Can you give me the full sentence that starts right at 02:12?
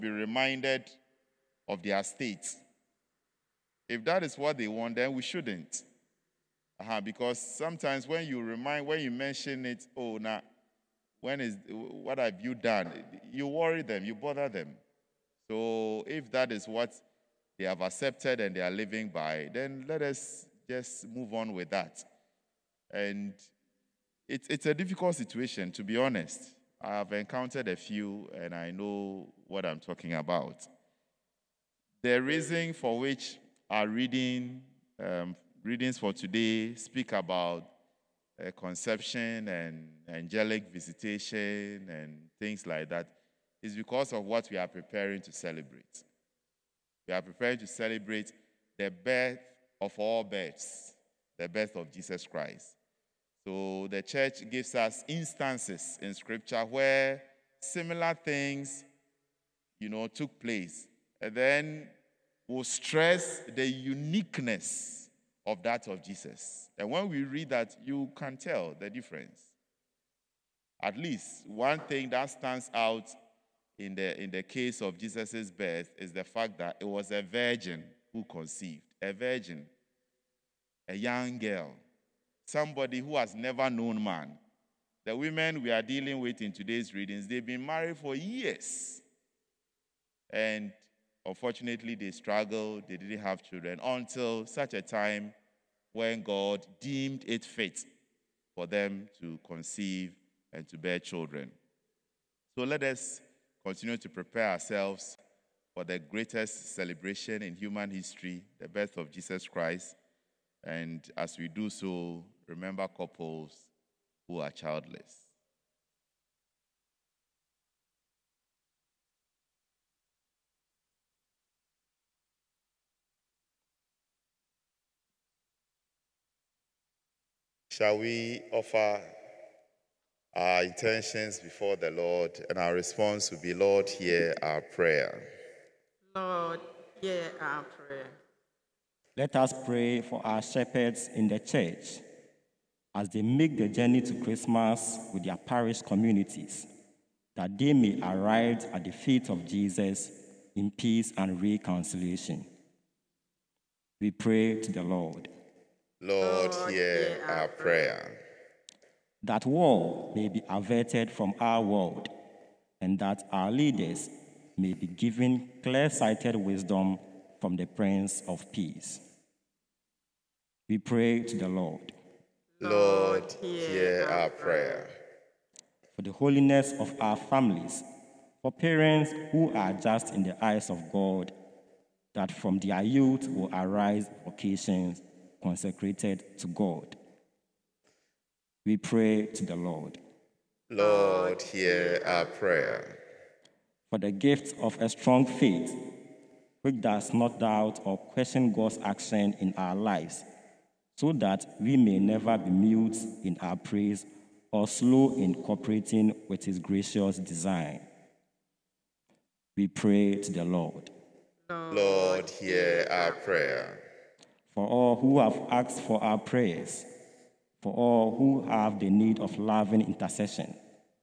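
And our response will be Lord, hear our prayer.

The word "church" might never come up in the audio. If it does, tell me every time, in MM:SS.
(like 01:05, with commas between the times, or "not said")
00:54, 02:21.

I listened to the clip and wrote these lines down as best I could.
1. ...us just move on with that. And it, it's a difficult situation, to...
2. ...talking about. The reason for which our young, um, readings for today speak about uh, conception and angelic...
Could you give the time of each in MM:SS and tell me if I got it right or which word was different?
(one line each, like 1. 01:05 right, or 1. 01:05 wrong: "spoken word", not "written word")
1. 00:20 right
2. 00:29 wrong: "reading", not "young".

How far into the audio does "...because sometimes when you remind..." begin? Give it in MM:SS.
00:06.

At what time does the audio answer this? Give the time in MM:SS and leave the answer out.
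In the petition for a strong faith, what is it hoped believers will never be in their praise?
03:22.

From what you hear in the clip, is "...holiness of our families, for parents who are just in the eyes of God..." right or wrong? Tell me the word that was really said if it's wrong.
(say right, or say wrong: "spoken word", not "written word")
right.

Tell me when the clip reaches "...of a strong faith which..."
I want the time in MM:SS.
03:14.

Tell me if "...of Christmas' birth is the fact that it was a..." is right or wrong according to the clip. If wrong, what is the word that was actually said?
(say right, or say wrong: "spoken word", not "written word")
wrong: "Jesus", not "Christmas".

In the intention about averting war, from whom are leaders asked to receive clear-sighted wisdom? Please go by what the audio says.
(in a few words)
The Prince of Peace.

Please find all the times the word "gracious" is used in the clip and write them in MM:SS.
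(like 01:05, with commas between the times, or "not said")
03:26.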